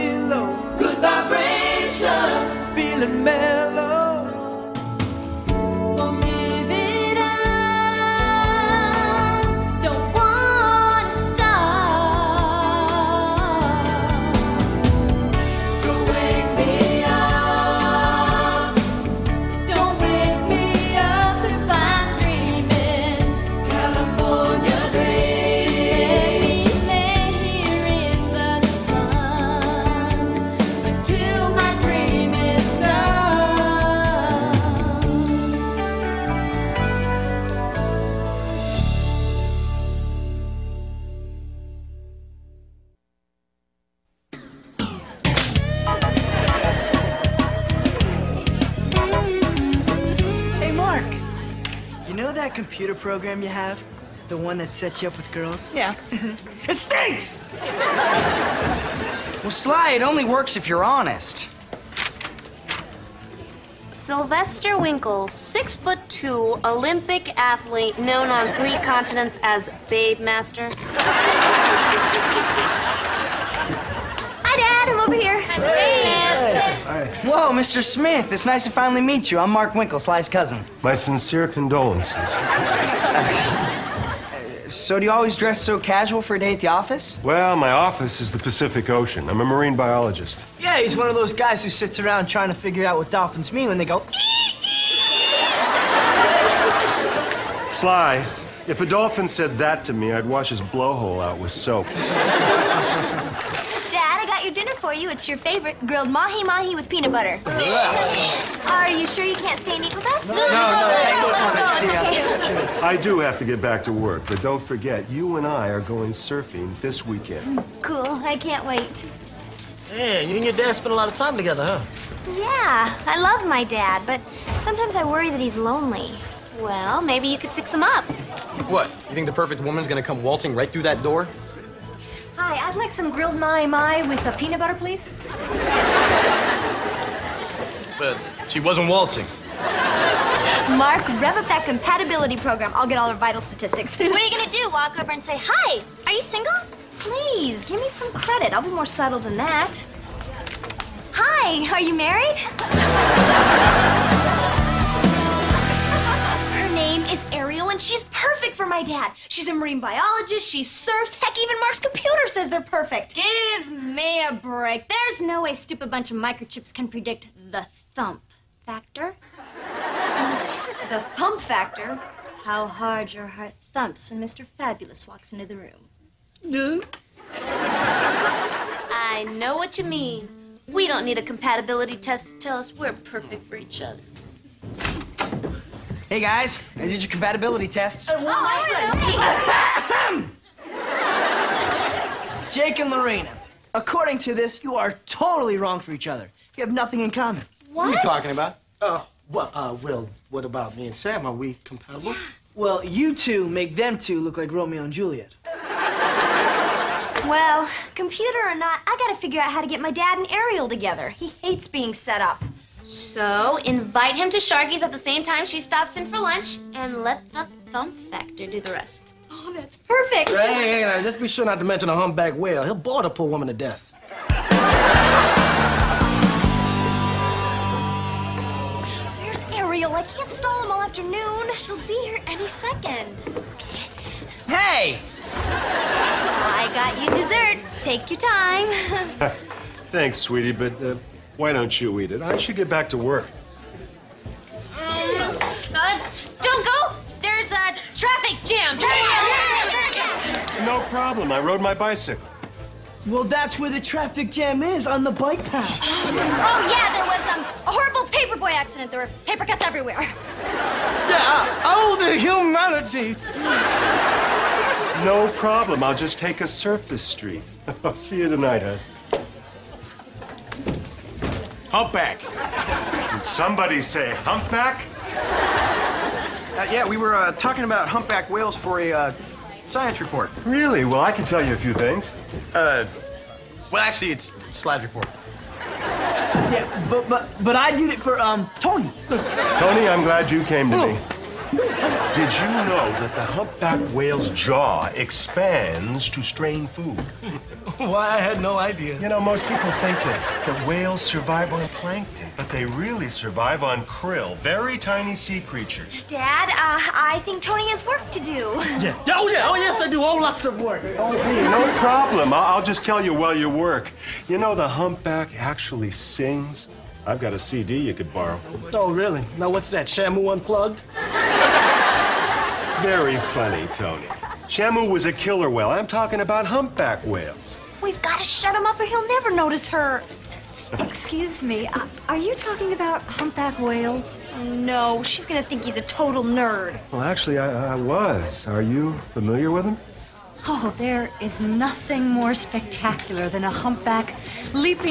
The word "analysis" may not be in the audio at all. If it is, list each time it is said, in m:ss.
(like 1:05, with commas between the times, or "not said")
not said.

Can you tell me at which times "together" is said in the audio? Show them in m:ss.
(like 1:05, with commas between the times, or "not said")
2:01, 3:30.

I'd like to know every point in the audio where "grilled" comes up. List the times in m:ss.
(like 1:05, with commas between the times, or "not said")
1:45, 2:13.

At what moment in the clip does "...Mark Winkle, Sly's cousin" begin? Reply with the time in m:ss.
1:19.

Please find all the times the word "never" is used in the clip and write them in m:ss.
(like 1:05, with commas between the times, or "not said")
5:29.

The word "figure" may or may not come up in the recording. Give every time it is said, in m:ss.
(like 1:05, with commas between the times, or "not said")
1:32, 3:29.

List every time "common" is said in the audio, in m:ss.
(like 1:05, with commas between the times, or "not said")
3:17.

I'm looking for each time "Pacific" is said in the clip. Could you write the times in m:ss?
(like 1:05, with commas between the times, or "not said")
1:28.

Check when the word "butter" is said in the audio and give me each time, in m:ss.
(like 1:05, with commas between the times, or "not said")
1:47, 2:14.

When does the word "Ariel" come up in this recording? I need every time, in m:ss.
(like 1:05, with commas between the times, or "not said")
3:30, 3:49.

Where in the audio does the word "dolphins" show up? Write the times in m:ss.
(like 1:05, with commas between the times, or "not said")
1:33, 1:38.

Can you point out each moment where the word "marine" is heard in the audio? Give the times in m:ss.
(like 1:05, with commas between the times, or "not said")
1:29, 2:39.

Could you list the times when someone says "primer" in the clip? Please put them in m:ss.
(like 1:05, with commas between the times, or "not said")
not said.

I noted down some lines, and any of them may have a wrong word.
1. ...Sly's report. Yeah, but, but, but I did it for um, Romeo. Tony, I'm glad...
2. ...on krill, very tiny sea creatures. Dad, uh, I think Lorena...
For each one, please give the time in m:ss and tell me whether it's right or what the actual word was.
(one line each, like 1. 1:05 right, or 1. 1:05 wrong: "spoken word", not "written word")
1. 4:44 wrong: "Tony", not "Romeo"
2. 5:03 wrong: "Tony", not "Lorena".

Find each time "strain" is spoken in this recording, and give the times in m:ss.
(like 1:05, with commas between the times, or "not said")
4:56.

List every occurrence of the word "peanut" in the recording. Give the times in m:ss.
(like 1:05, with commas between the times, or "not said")
1:46, 2:14.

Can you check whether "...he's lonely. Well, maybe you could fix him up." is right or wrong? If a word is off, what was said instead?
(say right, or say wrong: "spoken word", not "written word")
right.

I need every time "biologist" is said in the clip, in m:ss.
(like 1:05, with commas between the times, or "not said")
1:29, 2:39.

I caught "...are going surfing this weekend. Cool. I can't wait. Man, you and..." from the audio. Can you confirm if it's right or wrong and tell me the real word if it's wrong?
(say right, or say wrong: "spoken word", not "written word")
right.